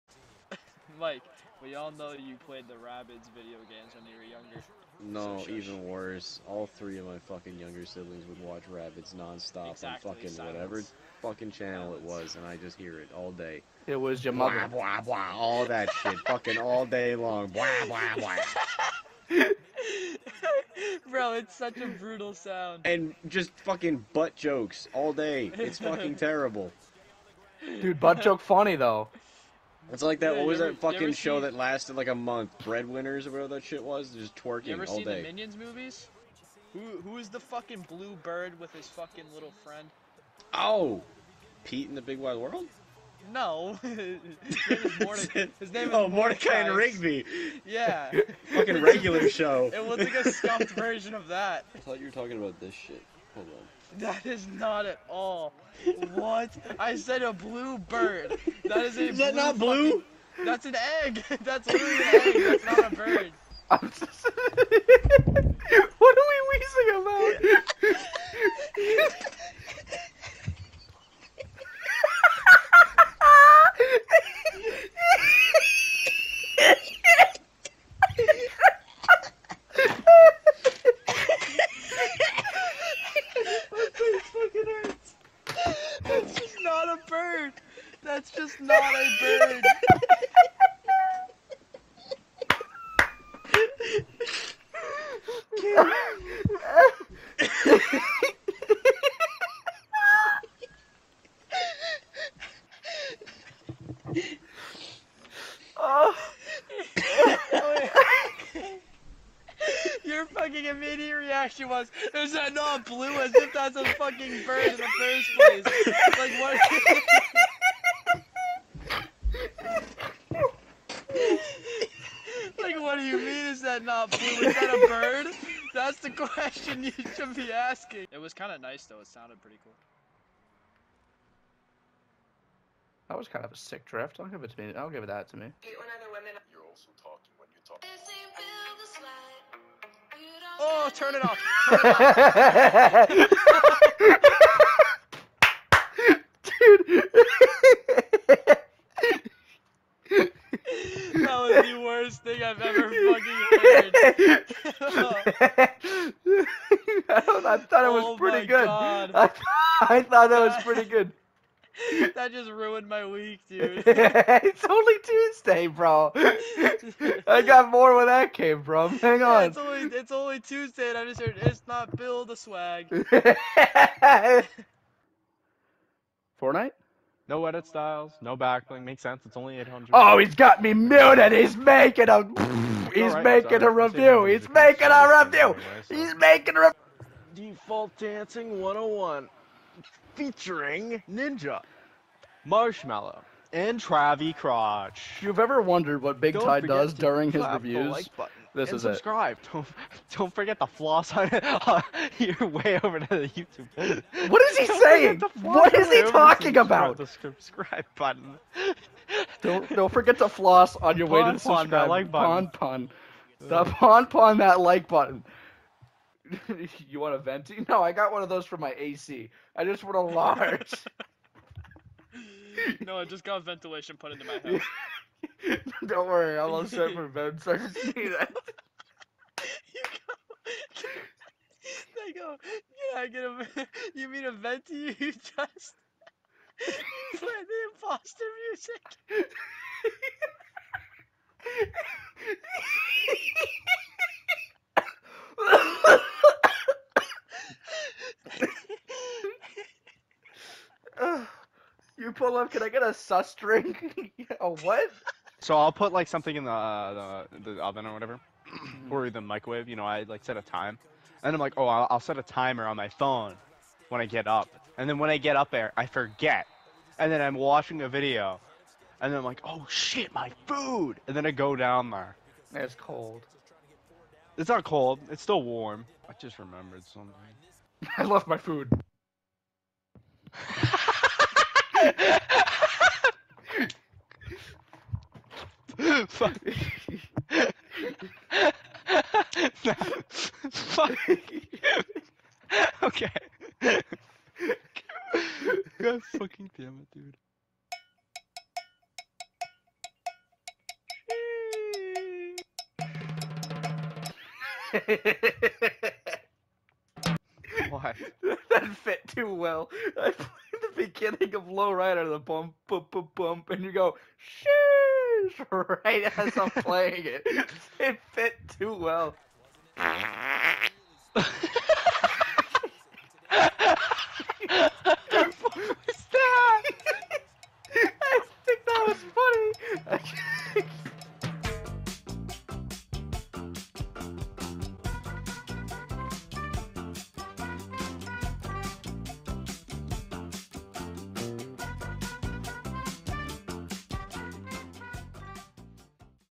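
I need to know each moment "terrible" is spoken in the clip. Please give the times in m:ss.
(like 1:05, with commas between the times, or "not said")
0:26.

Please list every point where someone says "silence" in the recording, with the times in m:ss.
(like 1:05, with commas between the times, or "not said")
0:10.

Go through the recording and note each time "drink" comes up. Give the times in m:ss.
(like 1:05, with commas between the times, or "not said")
4:13.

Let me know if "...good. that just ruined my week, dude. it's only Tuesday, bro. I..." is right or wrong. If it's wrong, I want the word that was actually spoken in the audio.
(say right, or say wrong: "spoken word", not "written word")
right.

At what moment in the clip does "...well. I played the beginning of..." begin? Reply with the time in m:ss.
5:09.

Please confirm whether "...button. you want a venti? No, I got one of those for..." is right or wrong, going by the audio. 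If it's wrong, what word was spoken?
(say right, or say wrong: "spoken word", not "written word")
right.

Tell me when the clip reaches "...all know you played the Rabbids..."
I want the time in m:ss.
0:01.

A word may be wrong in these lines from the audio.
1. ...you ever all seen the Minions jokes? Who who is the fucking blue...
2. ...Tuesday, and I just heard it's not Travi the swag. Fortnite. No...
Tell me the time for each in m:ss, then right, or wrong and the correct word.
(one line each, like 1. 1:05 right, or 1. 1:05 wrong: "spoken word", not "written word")
1. 0:34 wrong: "movies", not "jokes"
2. 2:50 wrong: "Bill", not "Travi".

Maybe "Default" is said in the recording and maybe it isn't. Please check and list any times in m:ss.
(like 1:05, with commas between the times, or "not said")
3:07.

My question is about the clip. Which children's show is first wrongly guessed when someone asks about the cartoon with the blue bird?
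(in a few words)
Peep and the Big Wide World.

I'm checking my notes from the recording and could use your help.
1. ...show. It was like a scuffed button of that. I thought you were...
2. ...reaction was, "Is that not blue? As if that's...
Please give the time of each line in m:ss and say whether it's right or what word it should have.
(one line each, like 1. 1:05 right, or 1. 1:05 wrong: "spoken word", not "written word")
1. 0:49 wrong: "version", not "button"
2. 1:51 right.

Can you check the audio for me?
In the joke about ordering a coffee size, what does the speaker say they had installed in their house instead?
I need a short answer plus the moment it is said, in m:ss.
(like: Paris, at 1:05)
ventilation, at 3:43.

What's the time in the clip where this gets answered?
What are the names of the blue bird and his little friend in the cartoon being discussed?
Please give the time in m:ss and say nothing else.
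0:46.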